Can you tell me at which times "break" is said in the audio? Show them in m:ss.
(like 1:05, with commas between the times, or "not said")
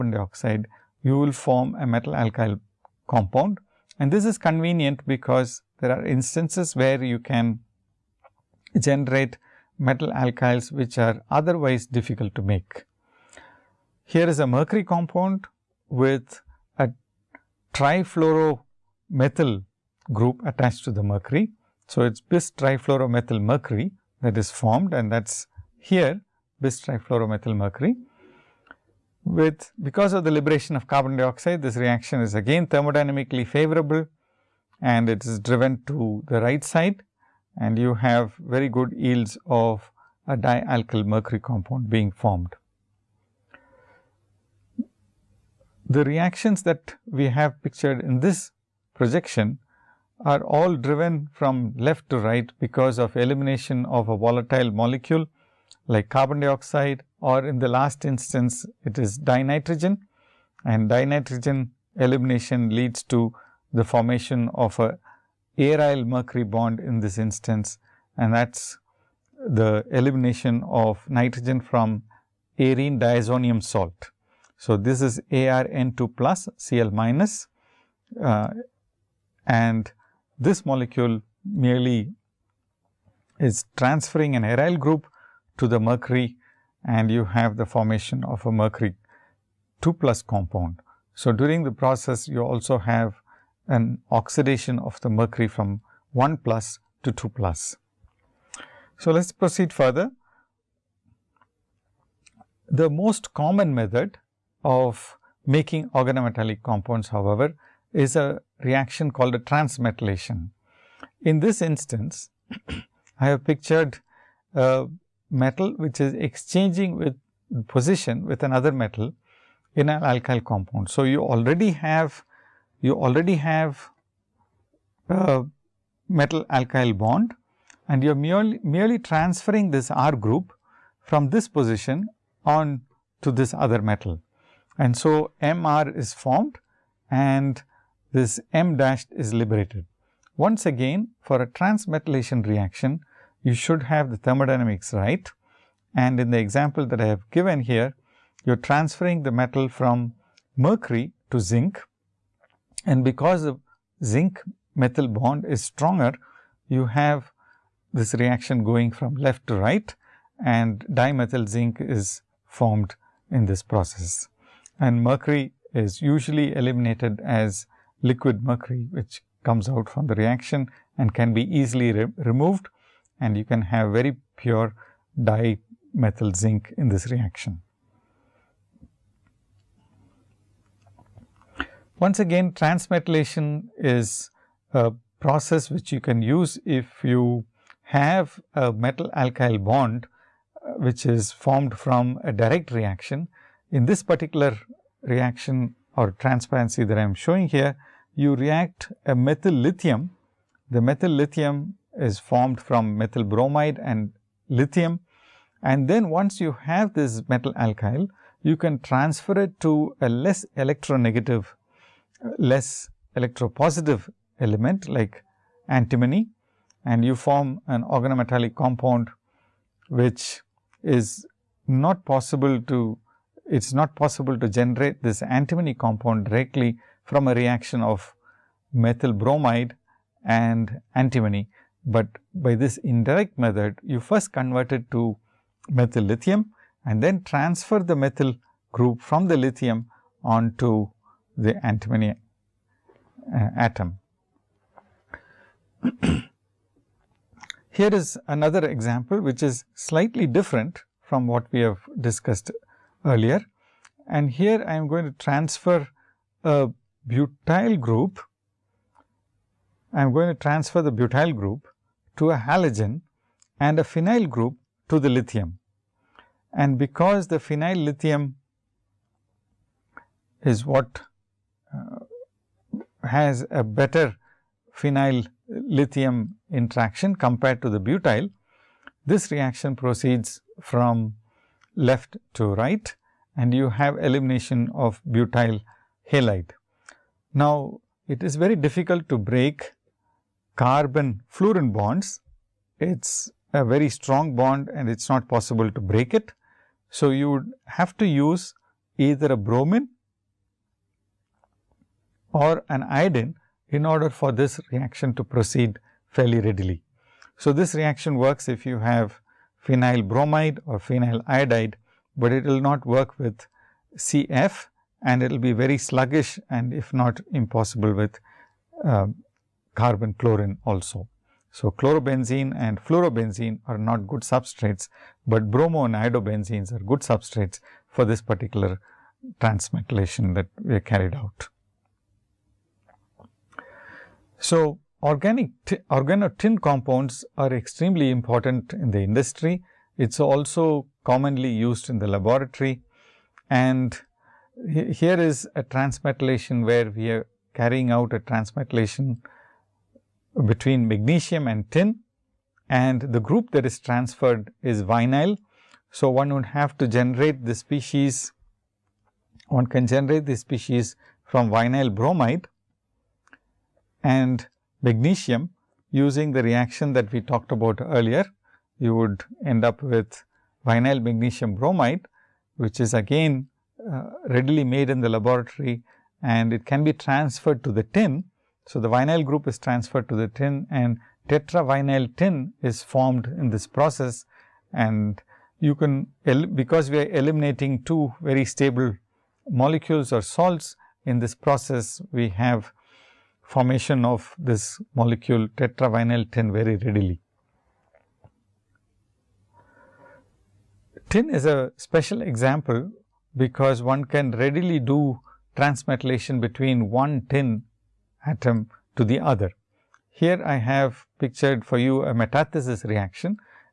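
4:49, 4:55.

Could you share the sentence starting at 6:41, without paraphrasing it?
Tin is a special example because one can readily do transmetallation between one tin atom to the other.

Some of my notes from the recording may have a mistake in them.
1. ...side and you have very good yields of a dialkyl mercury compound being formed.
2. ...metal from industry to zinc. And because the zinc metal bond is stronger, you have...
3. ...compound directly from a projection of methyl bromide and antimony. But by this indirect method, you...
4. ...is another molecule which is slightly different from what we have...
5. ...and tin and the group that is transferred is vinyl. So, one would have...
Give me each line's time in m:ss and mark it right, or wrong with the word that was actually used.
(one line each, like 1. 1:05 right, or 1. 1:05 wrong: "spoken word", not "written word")
1. 0:36 right
2. 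2:29 wrong: "mercury", not "industry"
3. 3:45 wrong: "reaction", not "projection"
4. 4:07 wrong: "example", not "molecule"
5. 5:51 right.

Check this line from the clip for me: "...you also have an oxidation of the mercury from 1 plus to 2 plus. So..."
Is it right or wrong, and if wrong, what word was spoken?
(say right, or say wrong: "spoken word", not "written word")
right.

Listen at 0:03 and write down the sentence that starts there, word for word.
And this is convenient because there are instances where you can generate metal alkyls which are otherwise difficult to make.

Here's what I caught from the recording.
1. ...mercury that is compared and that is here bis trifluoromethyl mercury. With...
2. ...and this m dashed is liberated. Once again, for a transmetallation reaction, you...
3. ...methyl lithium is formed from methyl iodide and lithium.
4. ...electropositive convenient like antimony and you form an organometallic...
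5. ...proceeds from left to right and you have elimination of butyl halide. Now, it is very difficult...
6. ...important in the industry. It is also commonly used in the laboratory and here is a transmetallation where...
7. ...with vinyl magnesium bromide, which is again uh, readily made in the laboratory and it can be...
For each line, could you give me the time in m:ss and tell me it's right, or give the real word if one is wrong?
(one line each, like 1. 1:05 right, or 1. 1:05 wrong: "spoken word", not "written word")
1. 0:23 wrong: "formed", not "compared"
2. 2:17 right
3. 3:20 wrong: "bromide", not "iodide"
4. 3:33 wrong: "element", not "convenient"
5. 4:39 right
6. 5:38 right
7. 6:09 right.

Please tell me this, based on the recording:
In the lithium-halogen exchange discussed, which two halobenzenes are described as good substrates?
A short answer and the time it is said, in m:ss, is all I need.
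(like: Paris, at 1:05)
bromo and iodobenzenes, at 5:25.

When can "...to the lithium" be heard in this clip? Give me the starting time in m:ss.
4:24.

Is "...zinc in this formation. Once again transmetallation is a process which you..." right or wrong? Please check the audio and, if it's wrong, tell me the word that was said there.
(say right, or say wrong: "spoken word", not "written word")
wrong: "reaction", not "formation".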